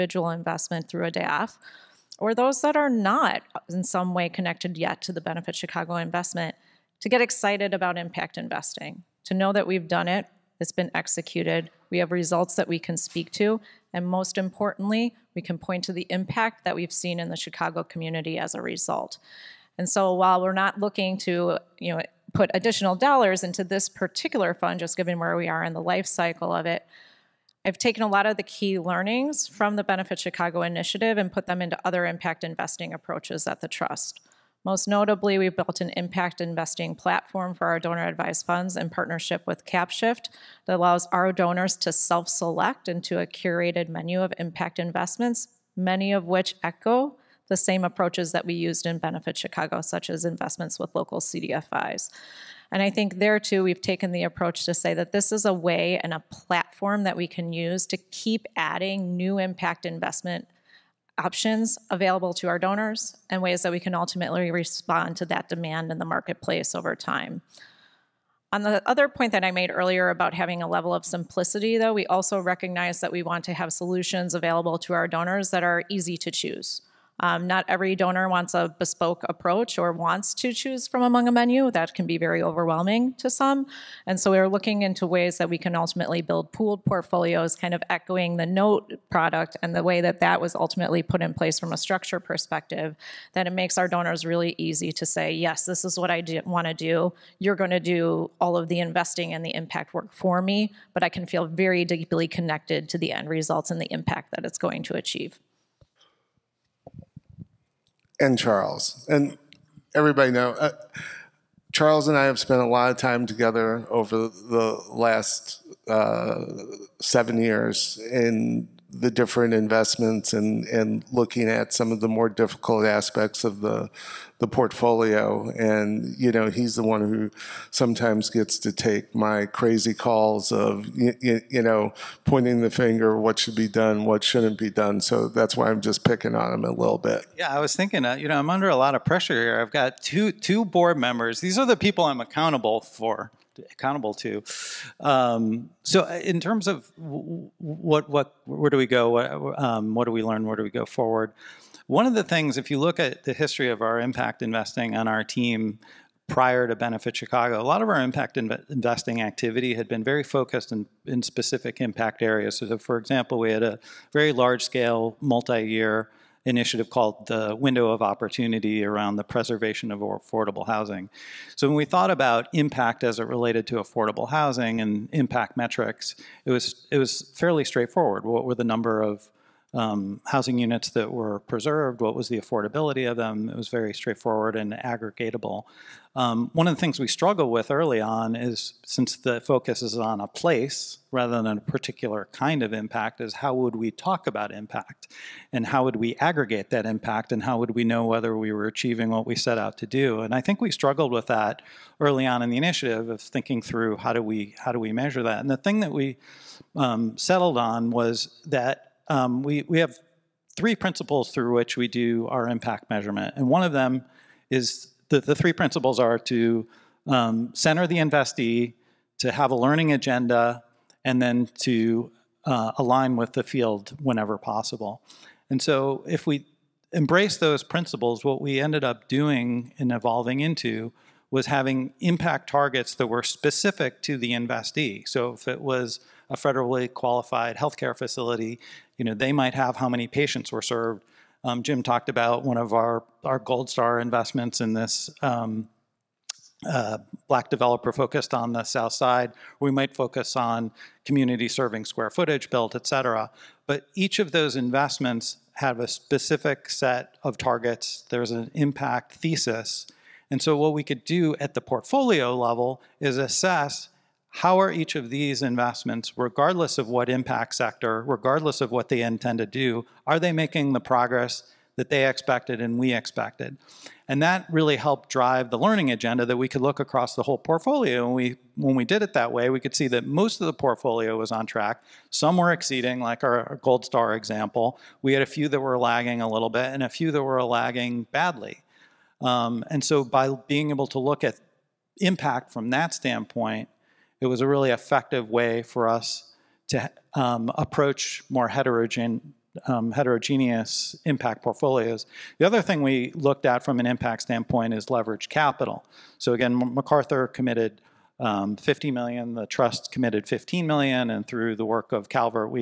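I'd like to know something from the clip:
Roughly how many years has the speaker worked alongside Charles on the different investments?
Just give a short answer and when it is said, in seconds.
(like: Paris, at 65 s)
7, at 117 s.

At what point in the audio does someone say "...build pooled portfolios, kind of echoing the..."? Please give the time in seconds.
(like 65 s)
86 s.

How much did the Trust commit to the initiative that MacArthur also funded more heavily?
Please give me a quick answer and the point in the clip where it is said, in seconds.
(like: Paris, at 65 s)
15 million, at 310 s.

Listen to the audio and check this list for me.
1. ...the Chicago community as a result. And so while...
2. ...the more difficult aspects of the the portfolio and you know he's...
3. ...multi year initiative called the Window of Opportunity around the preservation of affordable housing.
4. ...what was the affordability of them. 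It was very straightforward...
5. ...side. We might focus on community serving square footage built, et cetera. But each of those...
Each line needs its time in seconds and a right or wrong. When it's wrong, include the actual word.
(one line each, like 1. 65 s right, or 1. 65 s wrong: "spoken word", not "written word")
1. 17 s right
2. 121 s right
3. 165 s right
4. 182 s right
5. 248 s right.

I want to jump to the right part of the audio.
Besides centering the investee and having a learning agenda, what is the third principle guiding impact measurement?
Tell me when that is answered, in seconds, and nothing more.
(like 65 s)
222 s.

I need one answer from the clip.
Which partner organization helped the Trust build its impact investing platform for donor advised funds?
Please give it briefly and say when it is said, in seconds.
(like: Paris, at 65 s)
CapShift, at 39 s.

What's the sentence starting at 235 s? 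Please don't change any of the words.
So if it was a federally qualified healthcare facility, you know, they might have how many patients were served.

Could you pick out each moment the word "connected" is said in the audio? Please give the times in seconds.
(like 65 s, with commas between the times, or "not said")
4 s, 102 s.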